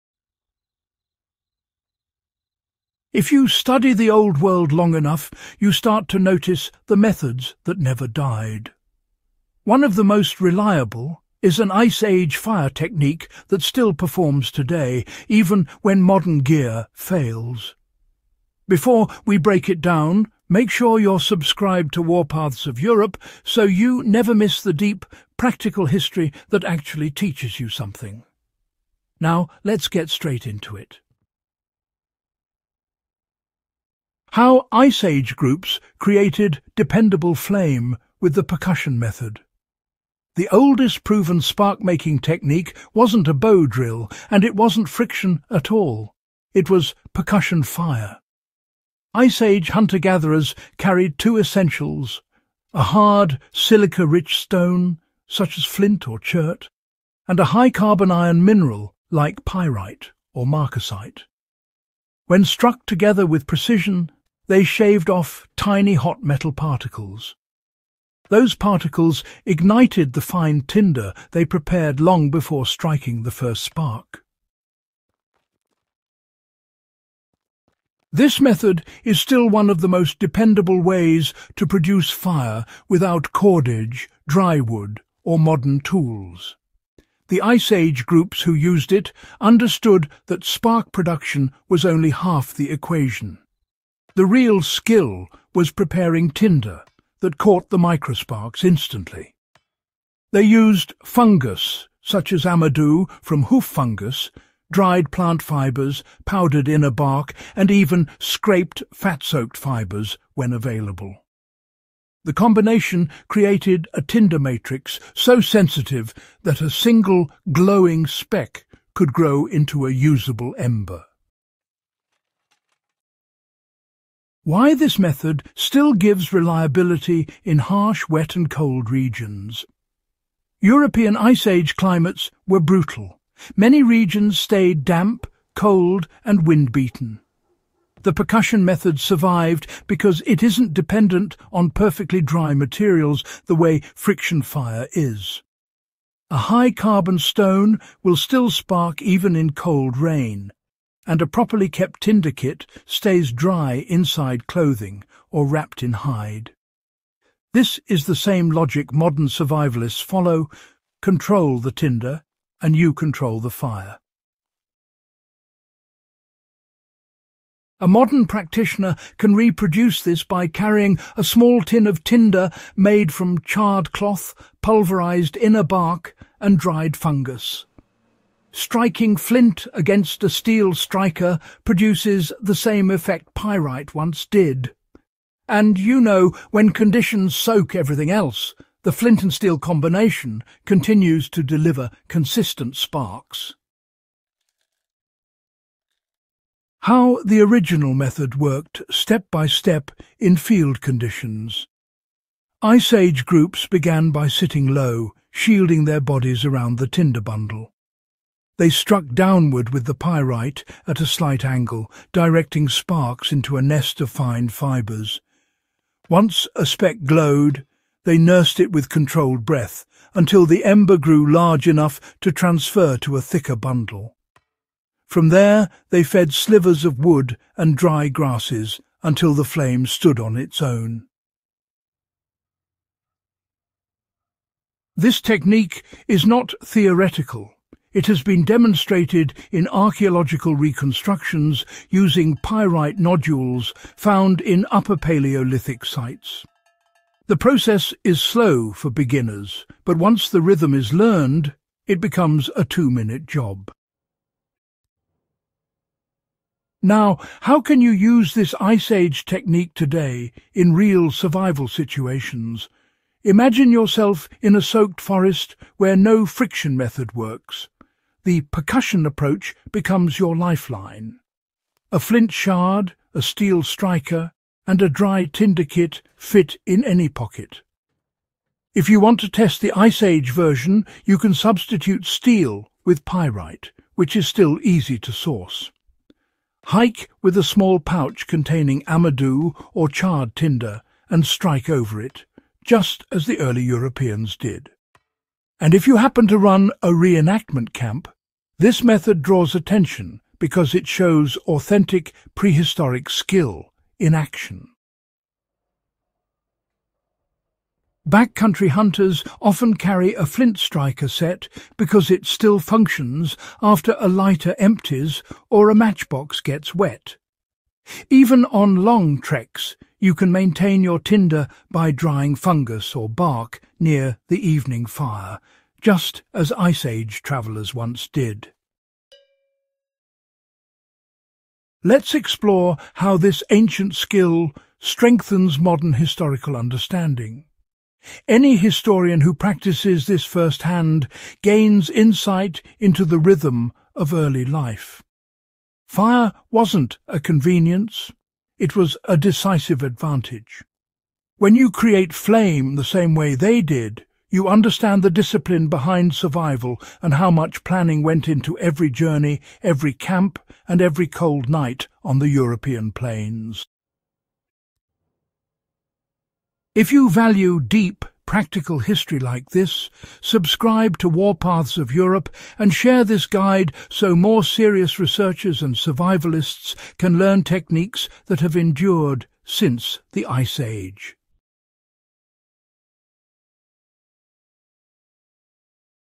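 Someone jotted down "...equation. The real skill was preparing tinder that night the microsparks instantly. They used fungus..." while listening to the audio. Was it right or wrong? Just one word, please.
wrong.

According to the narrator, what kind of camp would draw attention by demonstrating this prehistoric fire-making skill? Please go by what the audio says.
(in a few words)
A reenactment camp.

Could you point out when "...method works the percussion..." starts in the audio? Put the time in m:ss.
4:26.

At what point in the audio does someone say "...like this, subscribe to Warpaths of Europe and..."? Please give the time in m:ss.
6:09.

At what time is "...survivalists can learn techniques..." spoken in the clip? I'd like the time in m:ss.
6:15.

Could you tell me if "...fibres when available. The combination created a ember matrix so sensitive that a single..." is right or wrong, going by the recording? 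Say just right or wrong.
wrong.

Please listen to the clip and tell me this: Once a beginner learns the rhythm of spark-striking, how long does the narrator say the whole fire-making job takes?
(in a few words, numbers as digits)
2 minutes.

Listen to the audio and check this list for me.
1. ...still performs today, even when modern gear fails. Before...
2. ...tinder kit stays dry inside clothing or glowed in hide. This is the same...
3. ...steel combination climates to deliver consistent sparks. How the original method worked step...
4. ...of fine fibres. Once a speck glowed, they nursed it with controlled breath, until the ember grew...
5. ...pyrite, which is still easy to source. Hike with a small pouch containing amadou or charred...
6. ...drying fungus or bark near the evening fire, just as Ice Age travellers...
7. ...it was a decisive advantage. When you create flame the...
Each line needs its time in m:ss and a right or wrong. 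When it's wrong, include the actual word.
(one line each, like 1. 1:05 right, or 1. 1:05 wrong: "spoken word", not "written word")
1. 0:13 right
2. 2:32 wrong: "wrapped", not "glowed"
3. 3:09 wrong: "continues", not "climates"
4. 3:34 right
5. 4:43 right
6. 5:21 right
7. 5:48 right.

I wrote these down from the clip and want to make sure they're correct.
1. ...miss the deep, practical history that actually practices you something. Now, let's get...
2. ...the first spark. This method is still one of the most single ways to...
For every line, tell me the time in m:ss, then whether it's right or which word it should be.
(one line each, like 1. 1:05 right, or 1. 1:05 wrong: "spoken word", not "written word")
1. 0:24 wrong: "teaches", not "practices"
2. 1:13 wrong: "dependable", not "single".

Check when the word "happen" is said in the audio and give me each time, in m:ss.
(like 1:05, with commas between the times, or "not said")
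4:55.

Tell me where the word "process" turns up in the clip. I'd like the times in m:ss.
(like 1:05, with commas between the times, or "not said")
4:07.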